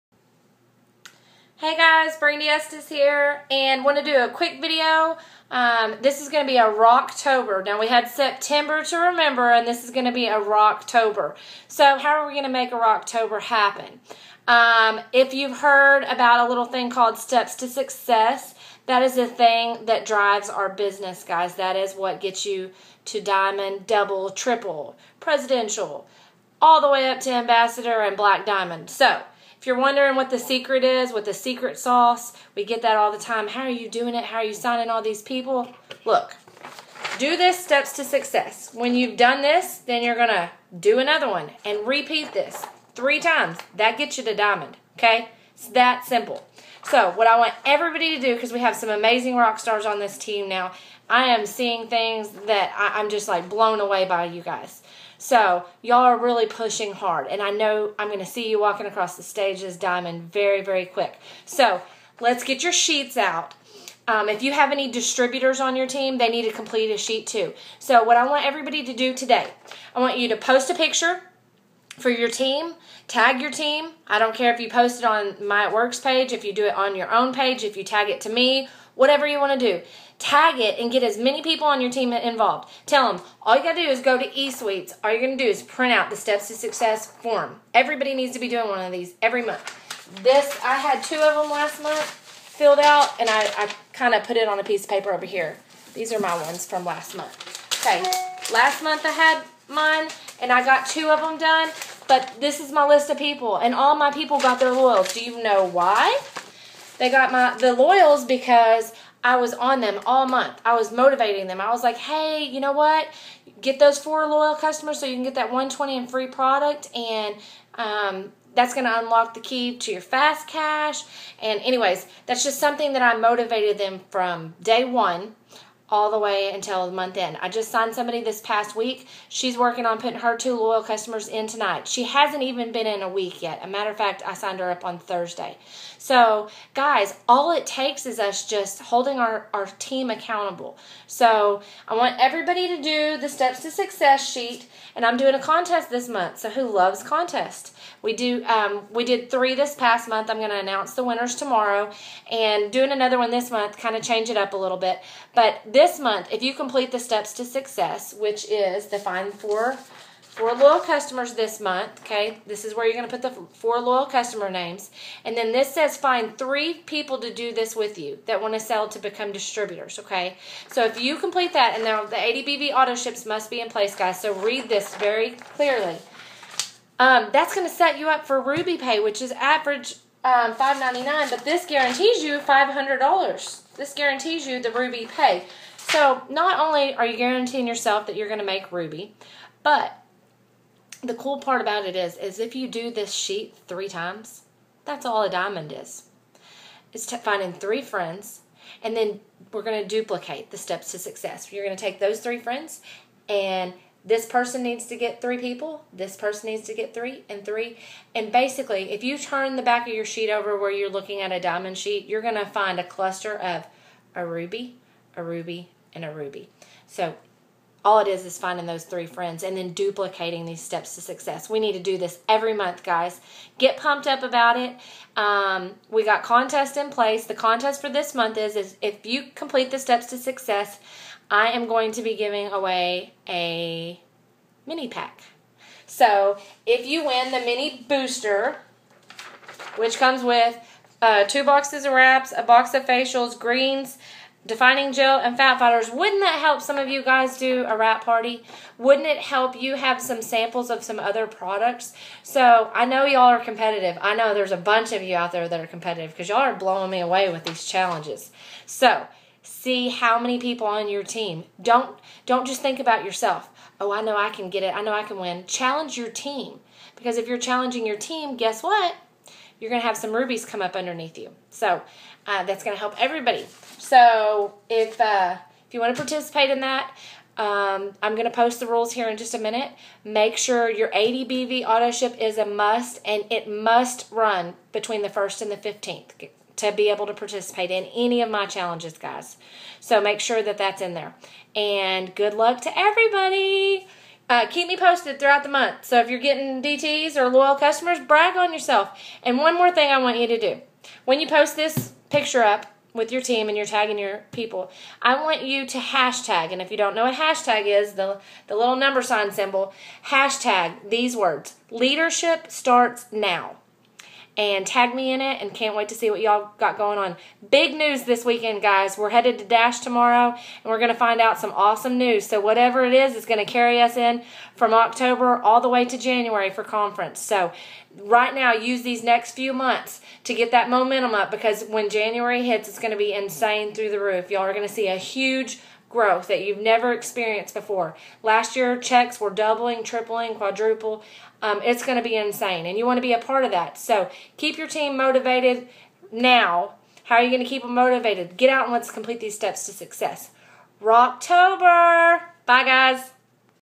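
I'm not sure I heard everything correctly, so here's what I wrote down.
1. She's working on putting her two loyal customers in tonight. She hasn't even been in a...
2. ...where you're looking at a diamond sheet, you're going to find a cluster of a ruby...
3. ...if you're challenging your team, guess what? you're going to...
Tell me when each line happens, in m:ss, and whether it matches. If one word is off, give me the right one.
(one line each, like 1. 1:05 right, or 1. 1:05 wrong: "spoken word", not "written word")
1. 2:09 right
2. 3:30 right
3. 4:27 right.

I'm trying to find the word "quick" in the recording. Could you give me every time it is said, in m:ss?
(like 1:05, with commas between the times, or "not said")
0:04, 1:00.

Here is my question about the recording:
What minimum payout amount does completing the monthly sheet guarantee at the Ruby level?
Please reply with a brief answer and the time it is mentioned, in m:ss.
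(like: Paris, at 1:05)
$500, at 3:02.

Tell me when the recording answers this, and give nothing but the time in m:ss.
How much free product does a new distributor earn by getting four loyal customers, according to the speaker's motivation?
1:55.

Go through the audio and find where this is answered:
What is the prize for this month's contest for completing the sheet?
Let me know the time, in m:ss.
3:54.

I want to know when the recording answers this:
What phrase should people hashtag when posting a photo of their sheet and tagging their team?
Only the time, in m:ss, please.
5:11.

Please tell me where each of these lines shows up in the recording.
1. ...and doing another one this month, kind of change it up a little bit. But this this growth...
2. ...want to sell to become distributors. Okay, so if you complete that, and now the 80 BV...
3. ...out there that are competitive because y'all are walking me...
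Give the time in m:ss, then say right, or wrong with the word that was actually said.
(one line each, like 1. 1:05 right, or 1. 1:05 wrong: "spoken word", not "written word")
1. 2:32 wrong: "month", not "growth"
2. 2:48 right
3. 4:15 wrong: "blowing", not "walking".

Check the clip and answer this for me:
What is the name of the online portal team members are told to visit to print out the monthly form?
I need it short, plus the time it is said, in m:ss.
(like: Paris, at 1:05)
eSuites, at 1:24.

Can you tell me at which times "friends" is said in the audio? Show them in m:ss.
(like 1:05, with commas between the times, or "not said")
3:17, 3:22, 3:39.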